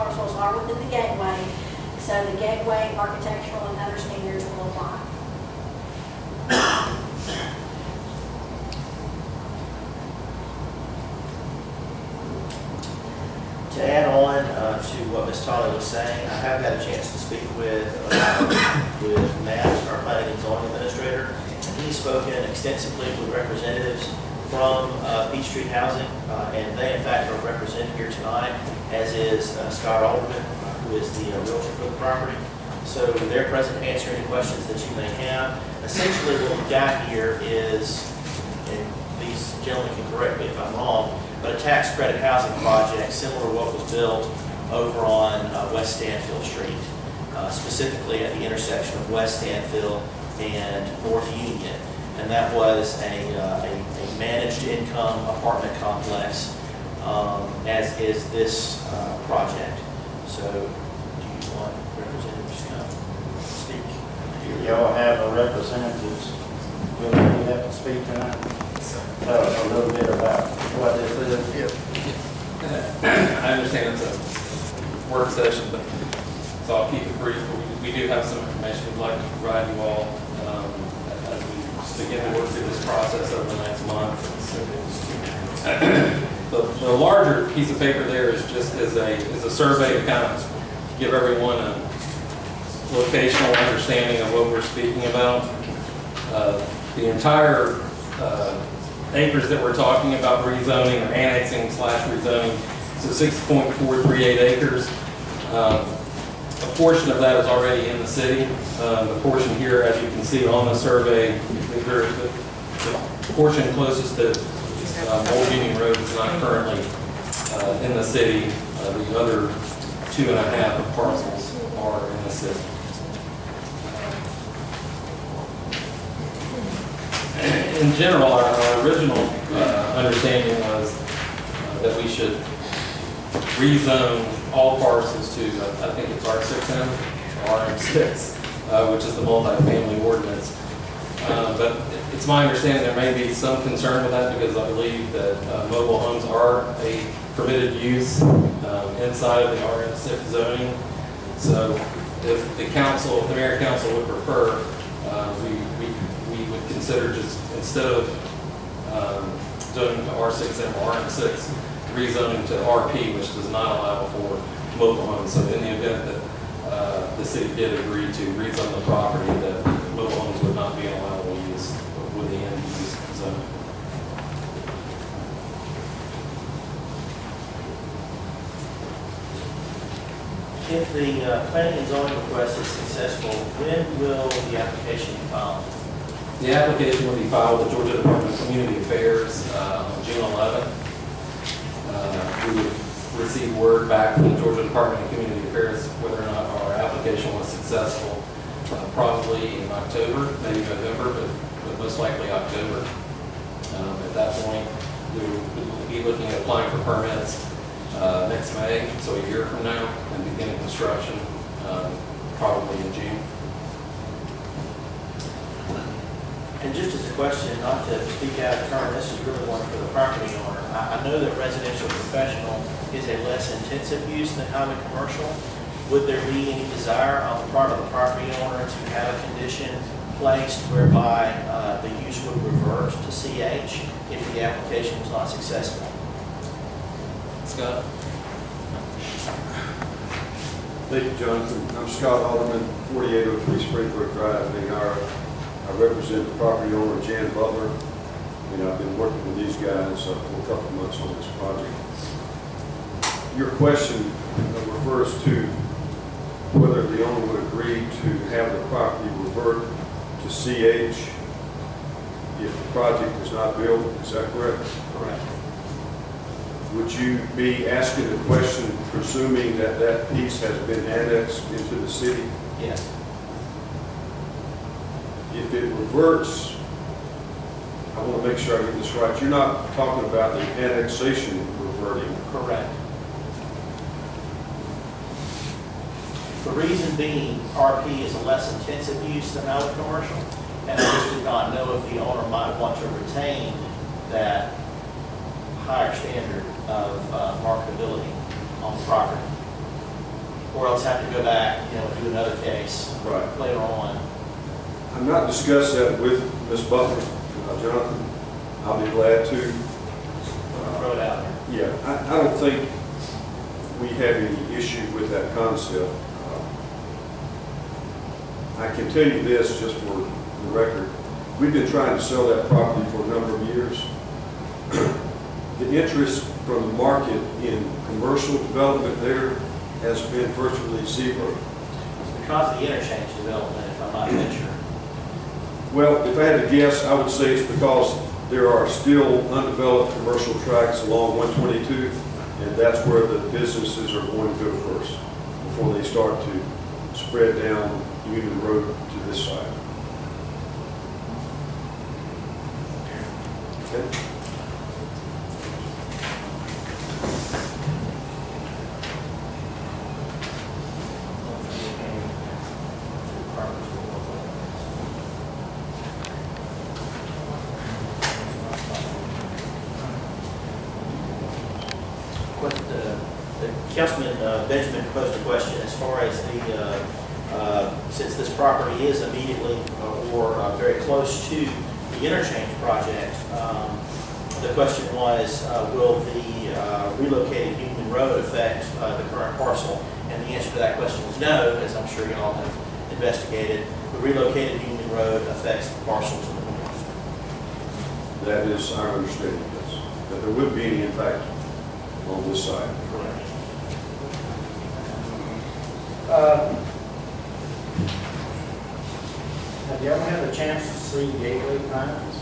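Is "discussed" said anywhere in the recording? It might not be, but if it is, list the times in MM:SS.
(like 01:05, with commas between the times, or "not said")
05:05.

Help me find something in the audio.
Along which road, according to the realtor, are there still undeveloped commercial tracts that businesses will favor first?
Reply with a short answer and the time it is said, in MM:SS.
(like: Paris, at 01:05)
122, at 05:41.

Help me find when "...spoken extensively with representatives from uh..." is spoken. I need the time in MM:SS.
00:21.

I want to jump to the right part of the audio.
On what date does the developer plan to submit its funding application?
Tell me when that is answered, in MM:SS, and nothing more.
03:10.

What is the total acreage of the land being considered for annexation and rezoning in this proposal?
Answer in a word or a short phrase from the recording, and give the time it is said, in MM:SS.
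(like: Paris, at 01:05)
6.438 acres, at 01:43.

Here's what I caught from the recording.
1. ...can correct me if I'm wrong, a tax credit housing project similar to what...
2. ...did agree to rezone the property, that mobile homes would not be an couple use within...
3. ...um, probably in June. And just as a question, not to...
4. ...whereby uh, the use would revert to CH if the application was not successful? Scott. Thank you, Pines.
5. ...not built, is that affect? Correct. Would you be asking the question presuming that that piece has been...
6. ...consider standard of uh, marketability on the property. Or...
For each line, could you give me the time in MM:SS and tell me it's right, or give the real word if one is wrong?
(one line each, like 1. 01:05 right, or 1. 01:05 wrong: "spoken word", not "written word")
1. 00:39 right
2. 02:47 wrong: "allowable", not "couple"
3. 03:31 right
4. 03:50 wrong: "Jonathan", not "Pines"
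5. 04:23 wrong: "correct", not "affect"
6. 04:55 wrong: "higher", not "consider".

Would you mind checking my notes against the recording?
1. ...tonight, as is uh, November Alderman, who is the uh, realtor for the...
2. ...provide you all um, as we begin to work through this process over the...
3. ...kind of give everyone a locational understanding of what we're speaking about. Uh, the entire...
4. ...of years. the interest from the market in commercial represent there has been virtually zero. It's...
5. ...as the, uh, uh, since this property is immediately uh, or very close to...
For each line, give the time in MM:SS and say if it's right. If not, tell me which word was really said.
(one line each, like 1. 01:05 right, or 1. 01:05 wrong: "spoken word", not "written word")
1. 00:28 wrong: "Scott", not "November"
2. 01:19 right
3. 01:30 right
4. 05:23 wrong: "development", not "represent"
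5. 06:16 right.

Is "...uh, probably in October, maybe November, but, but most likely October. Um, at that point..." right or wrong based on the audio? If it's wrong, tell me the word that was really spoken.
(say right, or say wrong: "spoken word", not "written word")
right.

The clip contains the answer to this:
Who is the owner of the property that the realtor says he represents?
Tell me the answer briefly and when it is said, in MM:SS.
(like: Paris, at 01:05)
Jan Butler, at 04:07.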